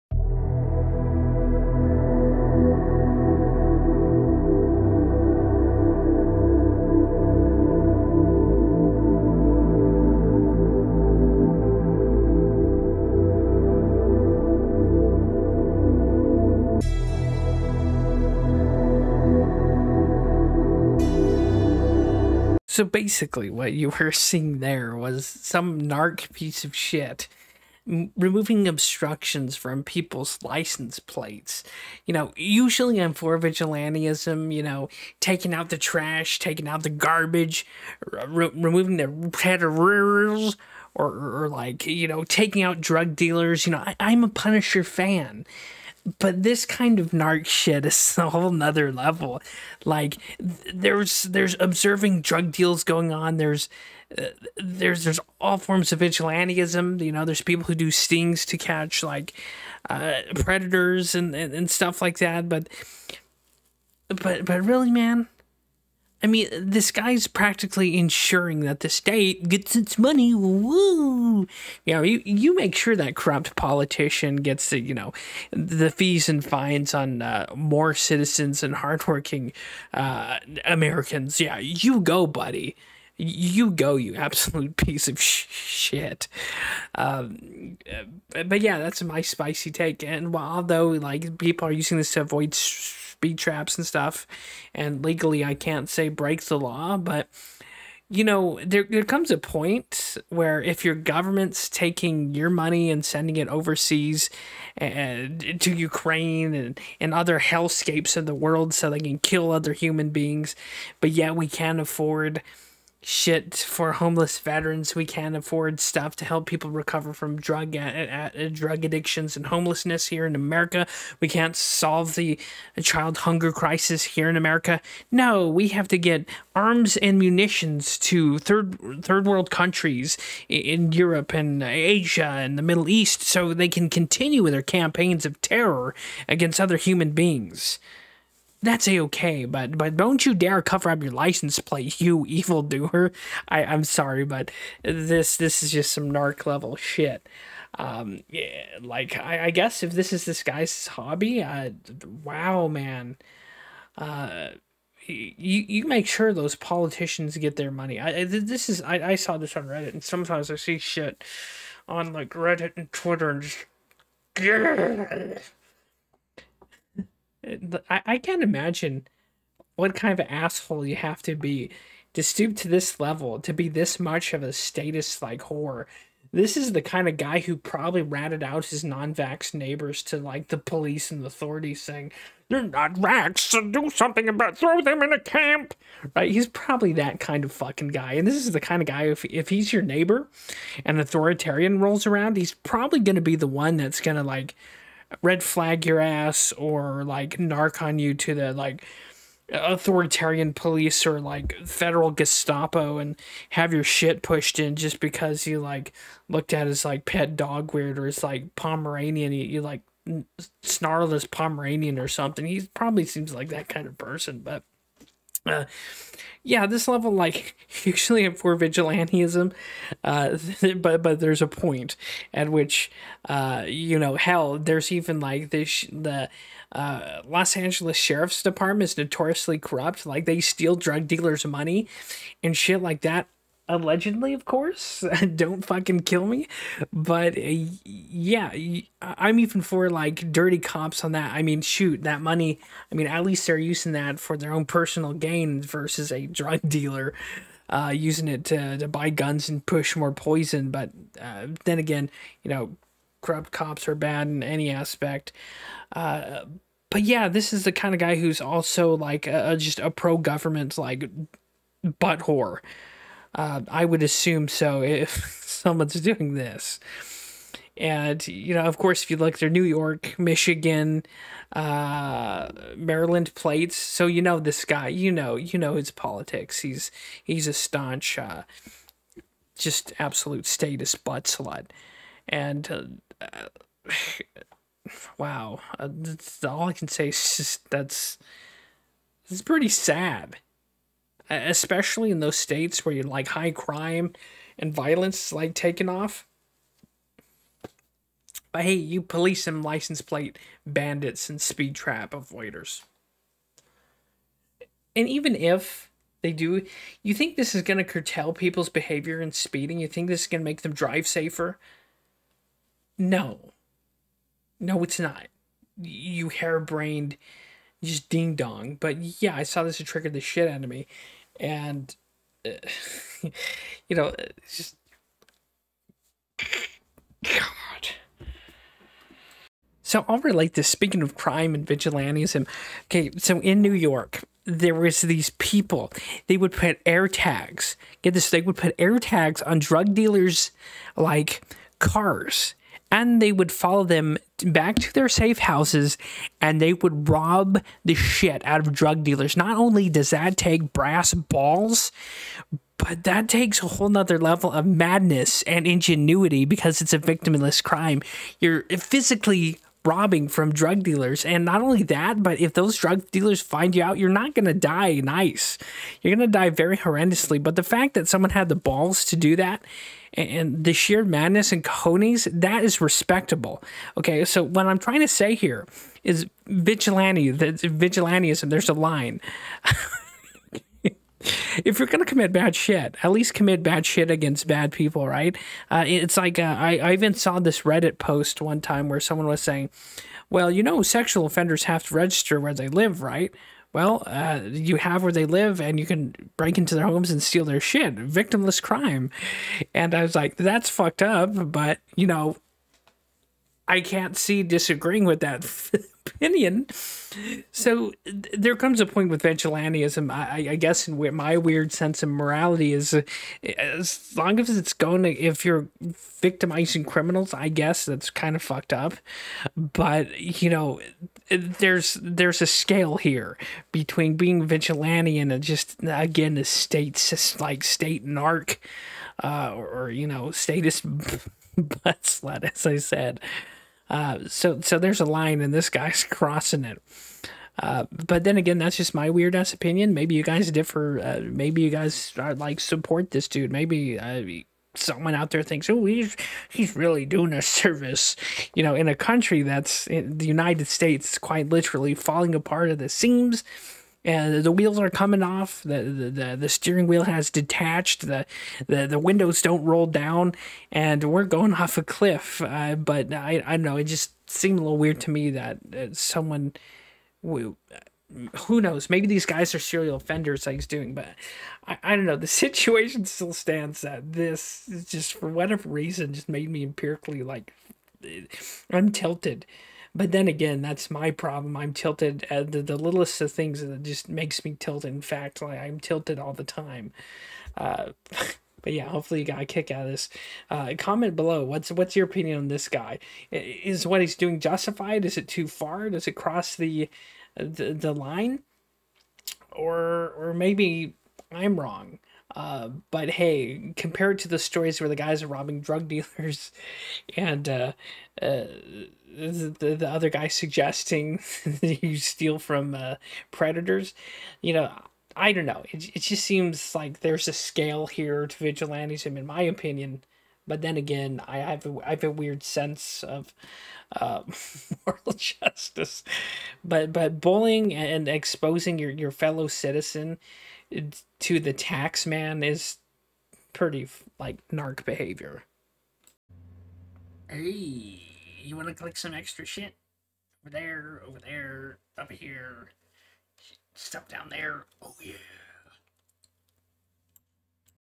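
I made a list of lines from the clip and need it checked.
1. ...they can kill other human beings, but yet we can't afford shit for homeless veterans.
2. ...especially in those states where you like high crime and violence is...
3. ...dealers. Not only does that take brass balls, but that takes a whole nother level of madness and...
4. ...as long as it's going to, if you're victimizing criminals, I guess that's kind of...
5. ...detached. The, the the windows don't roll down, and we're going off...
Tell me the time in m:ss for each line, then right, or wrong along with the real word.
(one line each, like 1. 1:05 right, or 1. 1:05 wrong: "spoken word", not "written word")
1. 1:48 right
2. 4:51 right
3. 5:49 right
4. 6:53 right
5. 7:37 right.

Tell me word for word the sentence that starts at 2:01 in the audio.
We can't solve the child hunger crisis here in America.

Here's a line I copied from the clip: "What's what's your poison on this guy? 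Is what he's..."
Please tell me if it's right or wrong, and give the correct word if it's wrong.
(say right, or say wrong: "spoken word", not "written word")
wrong: "opinion", not "poison".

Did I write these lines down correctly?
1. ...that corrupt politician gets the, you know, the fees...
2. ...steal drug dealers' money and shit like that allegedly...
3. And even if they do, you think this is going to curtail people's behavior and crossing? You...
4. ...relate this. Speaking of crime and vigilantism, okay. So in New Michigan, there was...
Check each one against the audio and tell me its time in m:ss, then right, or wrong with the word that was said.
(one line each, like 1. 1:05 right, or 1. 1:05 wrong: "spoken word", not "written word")
1. 1:12 right
2. 3:50 right
3. 5:04 wrong: "speeding", not "crossing"
4. 5:30 wrong: "York", not "Michigan".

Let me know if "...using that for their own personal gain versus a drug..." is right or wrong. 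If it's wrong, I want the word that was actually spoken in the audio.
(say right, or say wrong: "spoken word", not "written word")
right.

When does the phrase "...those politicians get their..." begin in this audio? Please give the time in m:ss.
2:36.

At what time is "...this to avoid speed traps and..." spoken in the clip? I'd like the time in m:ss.
1:31.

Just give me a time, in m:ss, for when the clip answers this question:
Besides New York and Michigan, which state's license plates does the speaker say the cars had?
4:32.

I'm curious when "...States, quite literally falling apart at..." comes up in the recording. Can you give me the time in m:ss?
7:30.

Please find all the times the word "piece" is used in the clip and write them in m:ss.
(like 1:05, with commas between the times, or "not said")
0:26, 1:24.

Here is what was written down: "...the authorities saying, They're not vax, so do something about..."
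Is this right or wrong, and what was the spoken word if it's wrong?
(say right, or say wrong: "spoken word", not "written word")
right.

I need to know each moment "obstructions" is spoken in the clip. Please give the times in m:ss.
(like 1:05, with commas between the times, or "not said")
0:28.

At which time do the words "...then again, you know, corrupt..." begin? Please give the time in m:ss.
4:11.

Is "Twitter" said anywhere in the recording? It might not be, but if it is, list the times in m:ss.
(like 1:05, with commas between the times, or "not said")
2:42.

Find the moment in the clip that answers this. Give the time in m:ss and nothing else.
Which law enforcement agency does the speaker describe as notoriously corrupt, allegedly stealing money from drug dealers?
3:47.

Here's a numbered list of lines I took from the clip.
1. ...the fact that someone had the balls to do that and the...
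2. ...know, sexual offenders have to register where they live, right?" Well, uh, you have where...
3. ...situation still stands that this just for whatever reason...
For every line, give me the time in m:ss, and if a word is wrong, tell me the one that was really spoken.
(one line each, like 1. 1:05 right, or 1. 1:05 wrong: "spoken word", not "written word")
1. 6:07 right
2. 6:30 right
3. 7:52 right.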